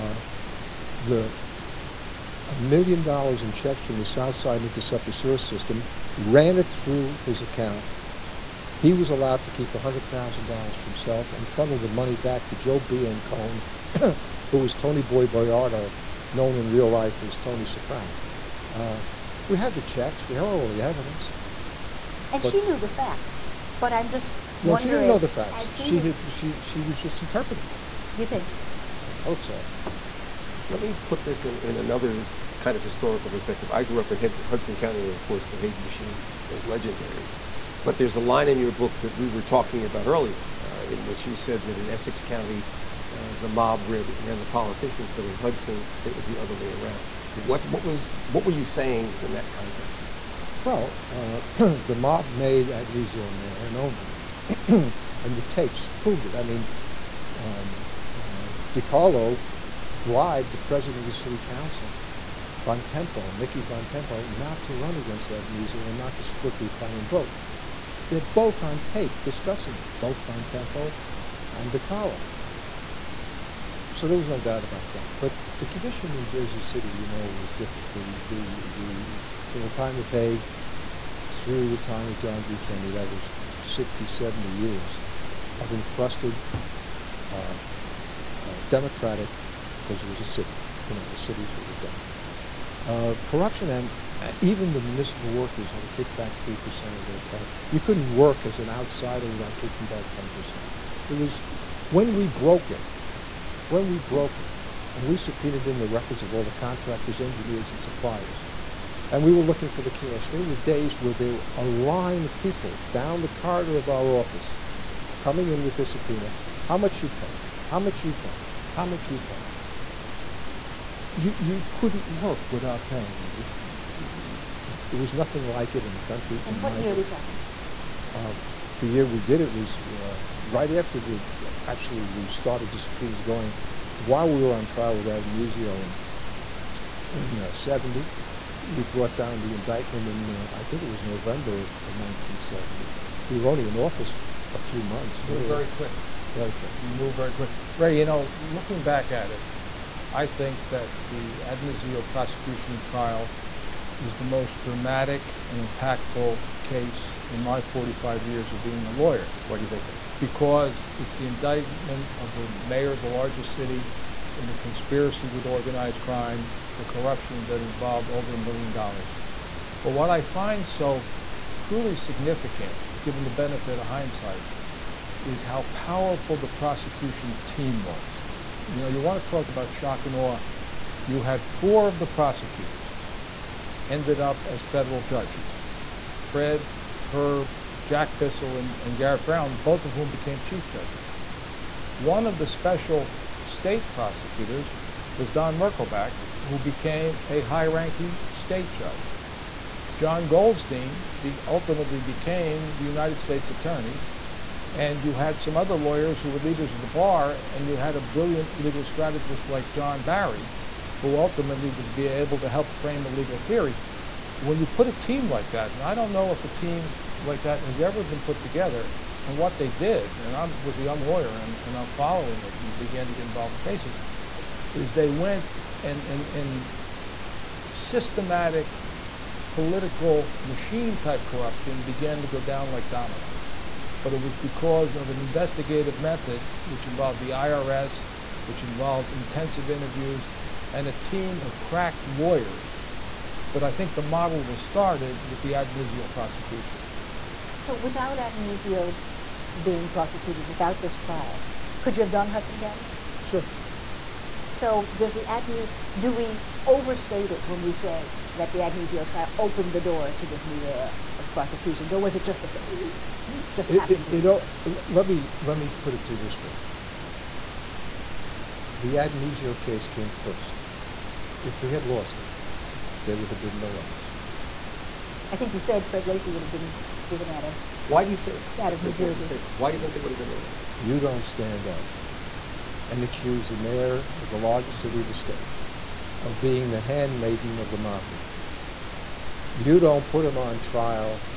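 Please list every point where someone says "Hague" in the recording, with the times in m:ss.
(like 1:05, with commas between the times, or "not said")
0:35, 1:20.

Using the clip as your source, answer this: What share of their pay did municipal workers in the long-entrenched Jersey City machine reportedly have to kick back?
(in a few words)
3%.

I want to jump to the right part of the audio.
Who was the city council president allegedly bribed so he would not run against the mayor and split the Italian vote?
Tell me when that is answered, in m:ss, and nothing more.
1:03.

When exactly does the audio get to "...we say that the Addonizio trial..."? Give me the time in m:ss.
4:17.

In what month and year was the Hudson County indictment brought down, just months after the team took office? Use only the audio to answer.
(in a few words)
November 1970.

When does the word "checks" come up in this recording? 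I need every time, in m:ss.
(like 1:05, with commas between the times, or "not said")
0:03, 0:19.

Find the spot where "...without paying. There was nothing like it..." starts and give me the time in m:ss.
2:02.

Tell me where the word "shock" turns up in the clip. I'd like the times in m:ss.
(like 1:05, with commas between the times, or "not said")
2:59.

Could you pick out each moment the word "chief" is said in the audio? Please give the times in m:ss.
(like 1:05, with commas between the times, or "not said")
3:10.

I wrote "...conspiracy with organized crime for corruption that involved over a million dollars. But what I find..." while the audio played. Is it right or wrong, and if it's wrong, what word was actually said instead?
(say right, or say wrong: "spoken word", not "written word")
right.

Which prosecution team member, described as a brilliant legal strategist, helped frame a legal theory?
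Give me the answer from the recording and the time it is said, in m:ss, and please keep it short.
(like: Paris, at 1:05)
John Barry, at 3:29.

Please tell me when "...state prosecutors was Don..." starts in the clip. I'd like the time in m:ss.
3:13.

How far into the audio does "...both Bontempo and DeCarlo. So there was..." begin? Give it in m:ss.
1:10.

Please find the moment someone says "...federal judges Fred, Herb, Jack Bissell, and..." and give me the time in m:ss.
3:04.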